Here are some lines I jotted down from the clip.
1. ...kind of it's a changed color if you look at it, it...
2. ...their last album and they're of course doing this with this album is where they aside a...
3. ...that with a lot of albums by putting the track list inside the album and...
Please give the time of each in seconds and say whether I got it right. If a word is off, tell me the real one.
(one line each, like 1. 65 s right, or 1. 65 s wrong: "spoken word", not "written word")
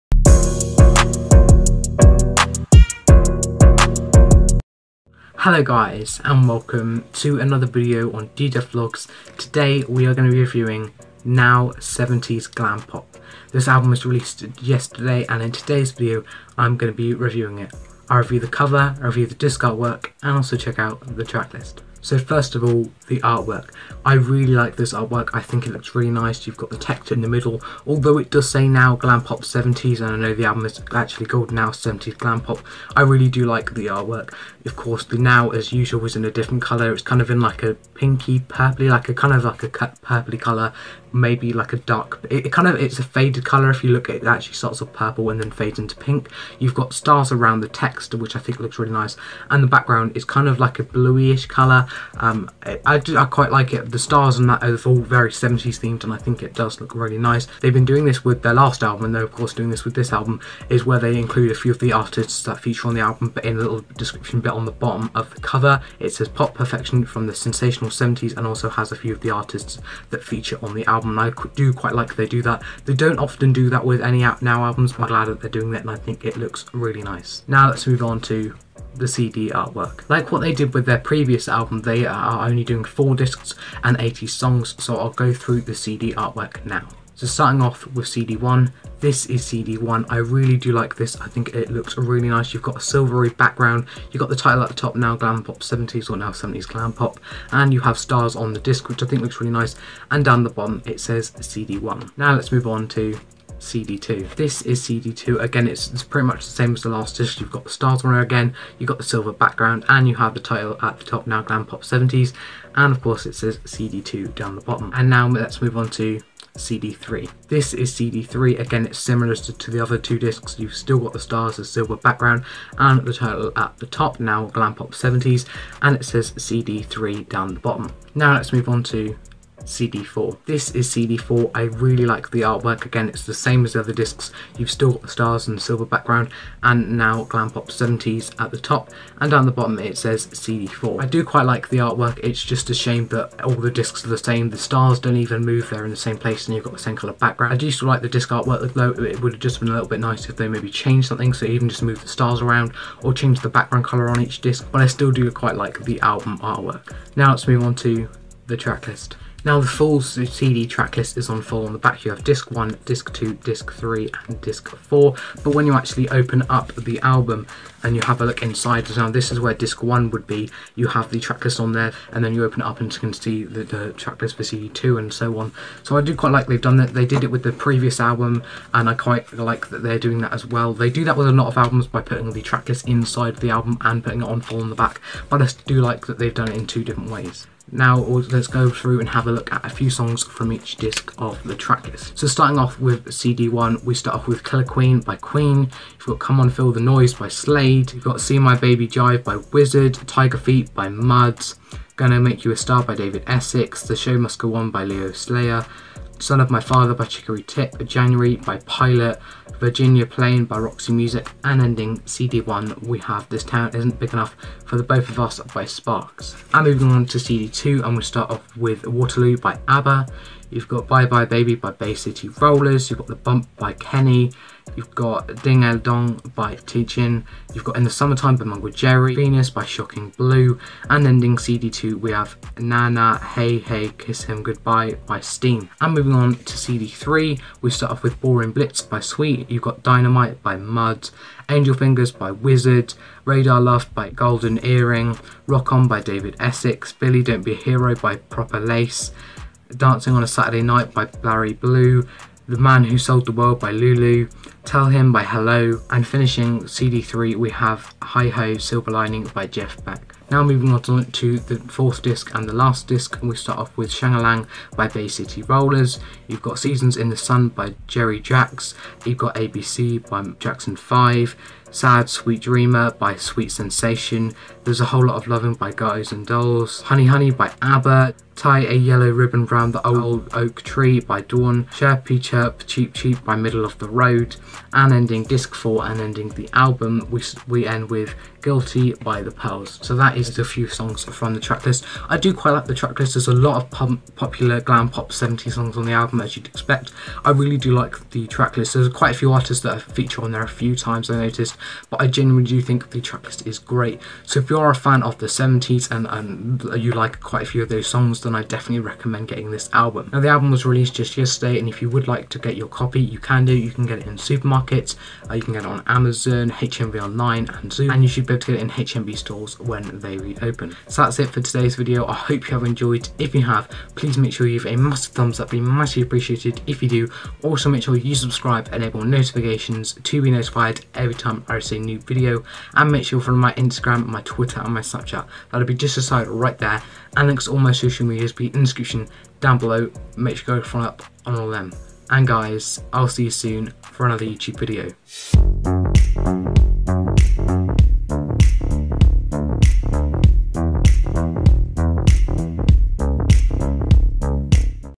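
1. 42 s wrong: "faded", not "changed"
2. 58 s wrong: "include", not "aside"
3. 181 s right.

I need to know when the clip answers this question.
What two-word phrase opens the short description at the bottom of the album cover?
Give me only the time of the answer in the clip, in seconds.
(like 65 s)
66 s.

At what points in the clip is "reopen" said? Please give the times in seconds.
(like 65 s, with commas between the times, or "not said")
320 s.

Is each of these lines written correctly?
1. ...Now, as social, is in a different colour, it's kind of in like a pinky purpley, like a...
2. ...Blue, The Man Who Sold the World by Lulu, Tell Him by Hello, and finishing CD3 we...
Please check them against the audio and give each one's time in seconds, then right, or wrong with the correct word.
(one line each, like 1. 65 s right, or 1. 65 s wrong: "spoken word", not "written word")
1. 35 s wrong: "usual", not "social"
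2. 251 s right.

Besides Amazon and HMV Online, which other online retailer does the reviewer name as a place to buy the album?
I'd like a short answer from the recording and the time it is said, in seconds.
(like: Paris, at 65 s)
Zoom, at 317 s.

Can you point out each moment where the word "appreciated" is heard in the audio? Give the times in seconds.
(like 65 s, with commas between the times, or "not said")
326 s.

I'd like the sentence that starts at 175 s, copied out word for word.
So I do quite like they've done that.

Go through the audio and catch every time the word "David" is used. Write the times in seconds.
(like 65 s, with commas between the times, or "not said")
202 s, 245 s.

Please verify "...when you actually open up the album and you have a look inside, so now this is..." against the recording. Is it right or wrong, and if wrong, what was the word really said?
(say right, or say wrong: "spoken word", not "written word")
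right.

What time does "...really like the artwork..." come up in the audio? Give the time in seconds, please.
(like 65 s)
131 s.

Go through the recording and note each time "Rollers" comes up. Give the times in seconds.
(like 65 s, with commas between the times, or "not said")
222 s, 265 s.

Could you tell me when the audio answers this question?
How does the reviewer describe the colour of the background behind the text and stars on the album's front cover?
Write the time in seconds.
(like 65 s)
50 s.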